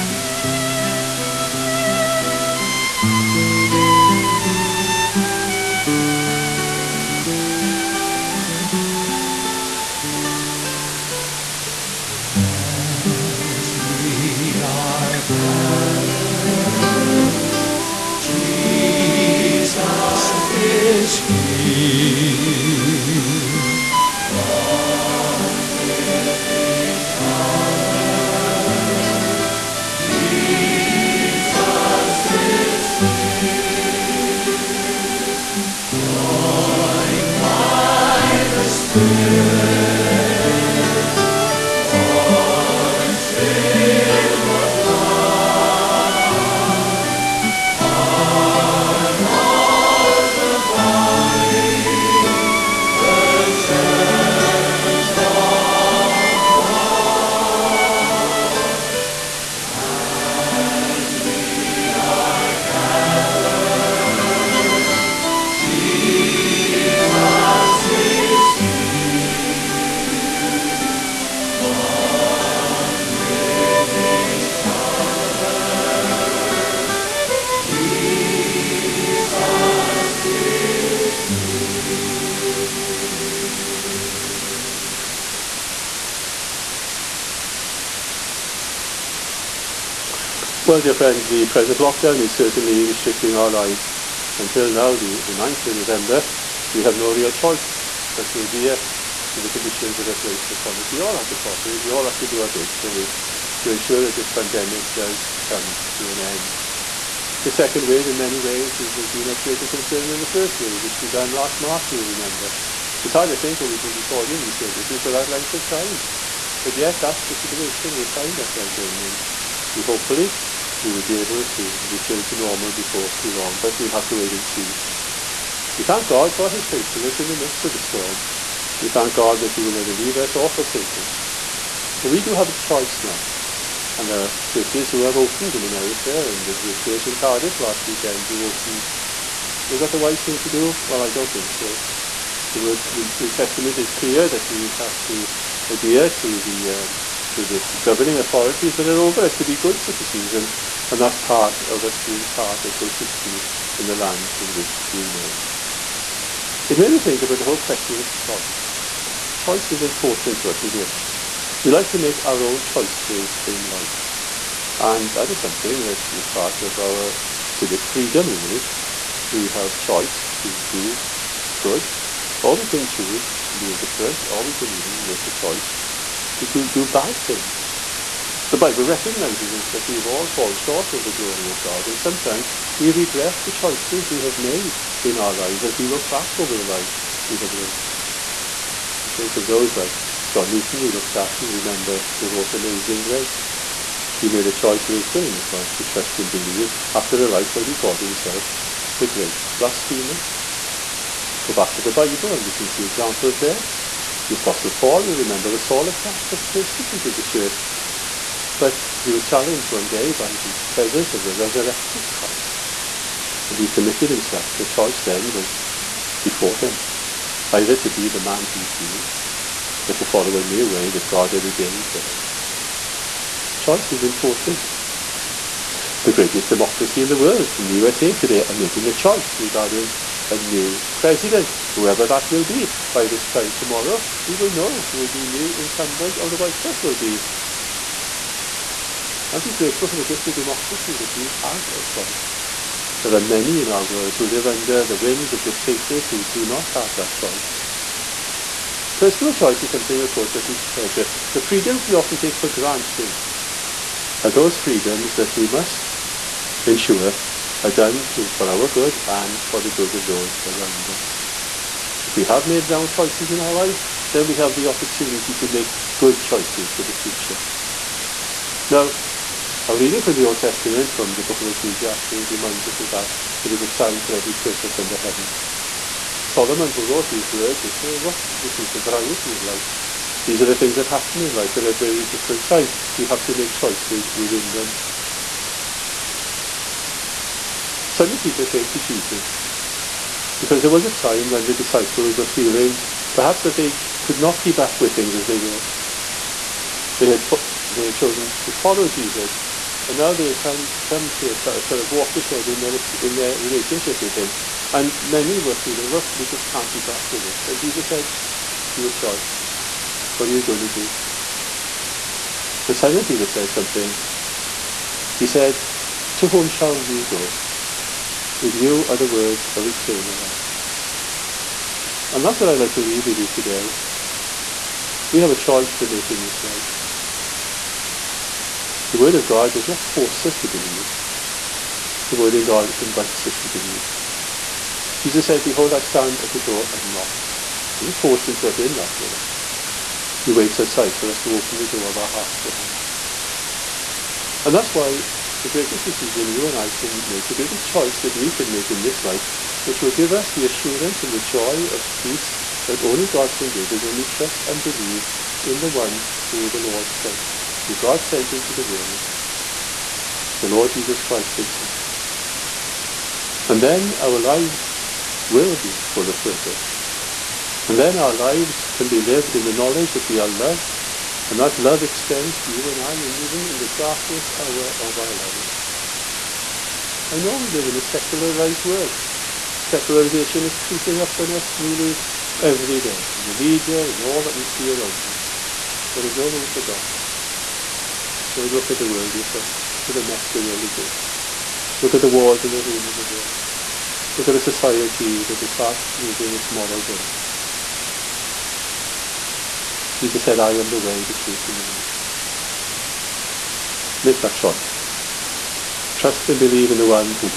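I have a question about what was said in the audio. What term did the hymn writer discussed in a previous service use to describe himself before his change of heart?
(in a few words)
the great blasphemer.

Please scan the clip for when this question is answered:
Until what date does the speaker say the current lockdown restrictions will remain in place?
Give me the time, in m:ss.
1:35.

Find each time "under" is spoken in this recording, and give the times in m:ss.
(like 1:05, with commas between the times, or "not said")
4:04, 4:34.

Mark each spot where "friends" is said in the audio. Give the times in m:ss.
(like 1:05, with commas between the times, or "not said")
1:30, 6:29.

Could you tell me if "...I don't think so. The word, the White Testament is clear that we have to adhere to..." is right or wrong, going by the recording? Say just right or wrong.
wrong.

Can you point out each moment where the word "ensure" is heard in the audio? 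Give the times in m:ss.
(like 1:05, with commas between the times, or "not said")
1:43, 4:16.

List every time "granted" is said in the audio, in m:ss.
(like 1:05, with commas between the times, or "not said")
4:12.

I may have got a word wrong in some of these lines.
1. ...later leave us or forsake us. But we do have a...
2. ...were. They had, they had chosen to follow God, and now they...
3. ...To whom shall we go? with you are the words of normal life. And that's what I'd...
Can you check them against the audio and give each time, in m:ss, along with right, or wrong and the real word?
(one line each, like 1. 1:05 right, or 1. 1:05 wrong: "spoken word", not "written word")
1. 2:09 wrong: "neither", not "later"
2. 4:55 wrong: "Jesus", not "God"
3. 5:16 wrong: "eternal", not "normal".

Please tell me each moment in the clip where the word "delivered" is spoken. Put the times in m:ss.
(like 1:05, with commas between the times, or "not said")
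not said.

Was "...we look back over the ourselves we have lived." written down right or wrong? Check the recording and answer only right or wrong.
wrong.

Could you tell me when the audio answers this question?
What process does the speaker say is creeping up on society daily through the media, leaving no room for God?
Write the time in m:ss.
6:19.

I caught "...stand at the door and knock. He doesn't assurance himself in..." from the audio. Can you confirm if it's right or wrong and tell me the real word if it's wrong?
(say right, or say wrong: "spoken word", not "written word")
wrong: "force", not "assurance".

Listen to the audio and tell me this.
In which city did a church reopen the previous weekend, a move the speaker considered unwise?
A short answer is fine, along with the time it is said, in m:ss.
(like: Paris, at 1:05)
Cardiff, at 2:17.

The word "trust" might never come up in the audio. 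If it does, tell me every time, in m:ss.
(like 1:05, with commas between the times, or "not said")
3:15, 5:54, 6:45.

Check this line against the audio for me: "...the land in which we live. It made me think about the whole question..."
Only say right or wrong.
right.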